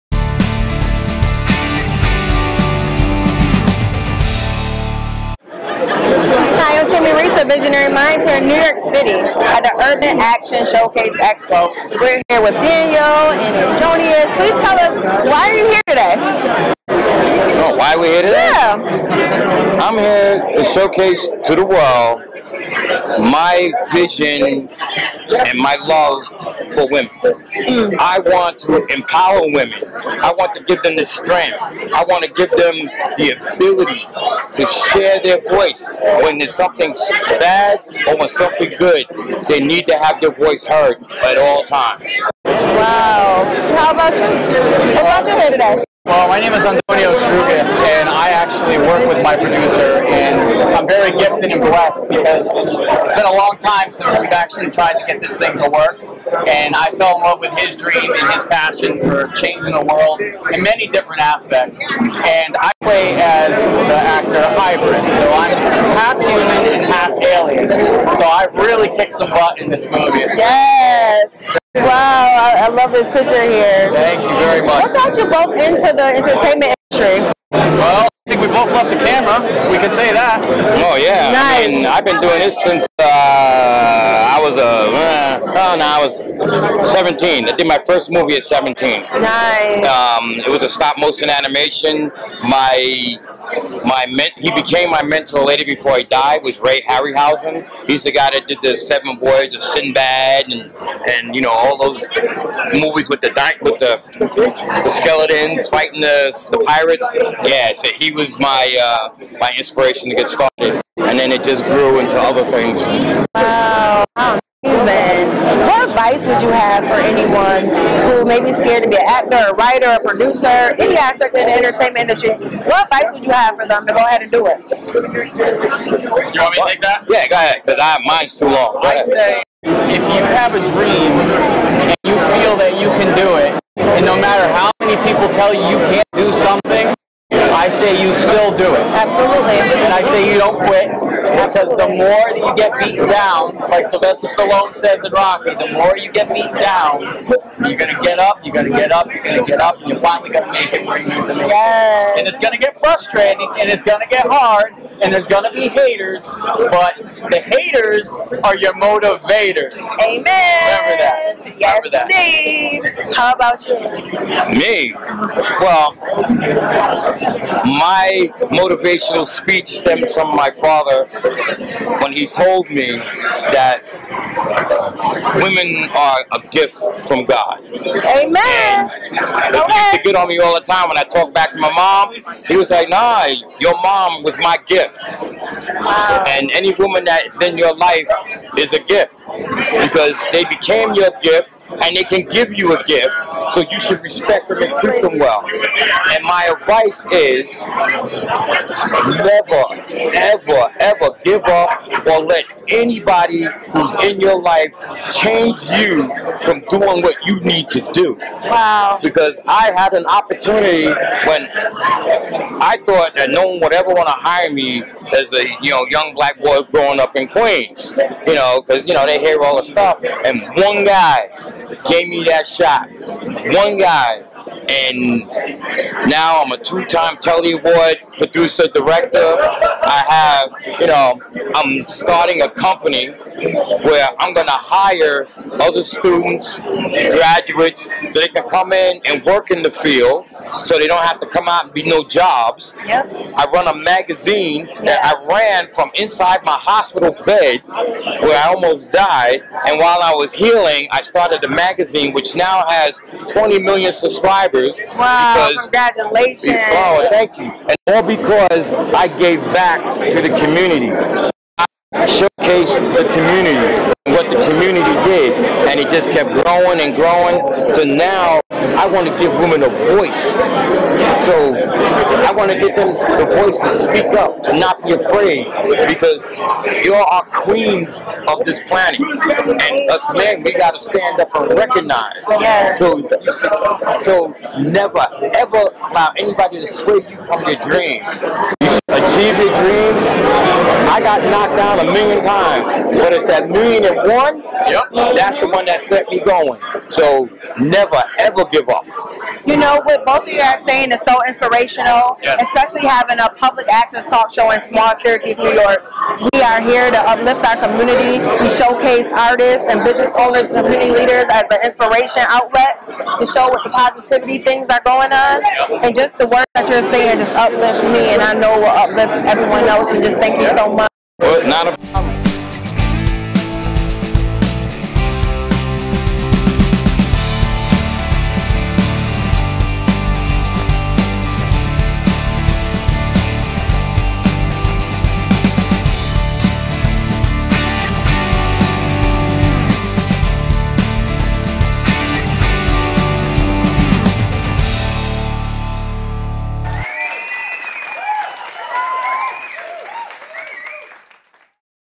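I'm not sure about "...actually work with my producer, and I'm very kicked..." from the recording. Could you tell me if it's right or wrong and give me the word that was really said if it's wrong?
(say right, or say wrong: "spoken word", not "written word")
wrong: "gifted", not "kicked".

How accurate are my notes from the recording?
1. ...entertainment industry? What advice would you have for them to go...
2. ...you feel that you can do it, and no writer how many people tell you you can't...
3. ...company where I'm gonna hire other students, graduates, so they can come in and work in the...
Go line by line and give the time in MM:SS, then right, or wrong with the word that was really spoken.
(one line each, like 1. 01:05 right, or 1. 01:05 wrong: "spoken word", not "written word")
1. 02:01 right
2. 02:12 wrong: "matter", not "writer"
3. 03:52 right.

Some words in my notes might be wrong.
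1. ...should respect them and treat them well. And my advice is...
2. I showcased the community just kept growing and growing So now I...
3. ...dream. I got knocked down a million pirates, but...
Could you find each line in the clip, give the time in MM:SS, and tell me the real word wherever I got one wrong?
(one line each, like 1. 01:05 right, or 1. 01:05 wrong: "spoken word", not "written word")
1. 03:13 right
2. 04:21 right
3. 04:49 wrong: "times", not "pirates".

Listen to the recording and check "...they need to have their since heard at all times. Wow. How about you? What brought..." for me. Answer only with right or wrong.
wrong.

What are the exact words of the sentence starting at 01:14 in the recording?
What got you both into the entertainment industry?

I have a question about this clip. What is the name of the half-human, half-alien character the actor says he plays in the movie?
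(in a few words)
Hybris.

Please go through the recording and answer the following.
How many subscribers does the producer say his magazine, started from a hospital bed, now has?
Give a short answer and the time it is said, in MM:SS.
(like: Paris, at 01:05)
20 million, at 04:13.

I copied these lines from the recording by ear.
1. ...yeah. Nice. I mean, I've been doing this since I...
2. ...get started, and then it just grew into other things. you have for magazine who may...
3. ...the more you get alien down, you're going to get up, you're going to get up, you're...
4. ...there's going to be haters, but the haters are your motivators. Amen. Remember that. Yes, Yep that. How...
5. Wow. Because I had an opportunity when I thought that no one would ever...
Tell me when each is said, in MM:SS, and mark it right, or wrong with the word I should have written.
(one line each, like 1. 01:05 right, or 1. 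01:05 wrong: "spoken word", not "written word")
1. 01:20 right
2. 01:50 wrong: "anyone", not "magazine"
3. 02:25 wrong: "beaten", not "alien"
4. 02:35 wrong: "Remember", not "Yep"
5. 03:28 right.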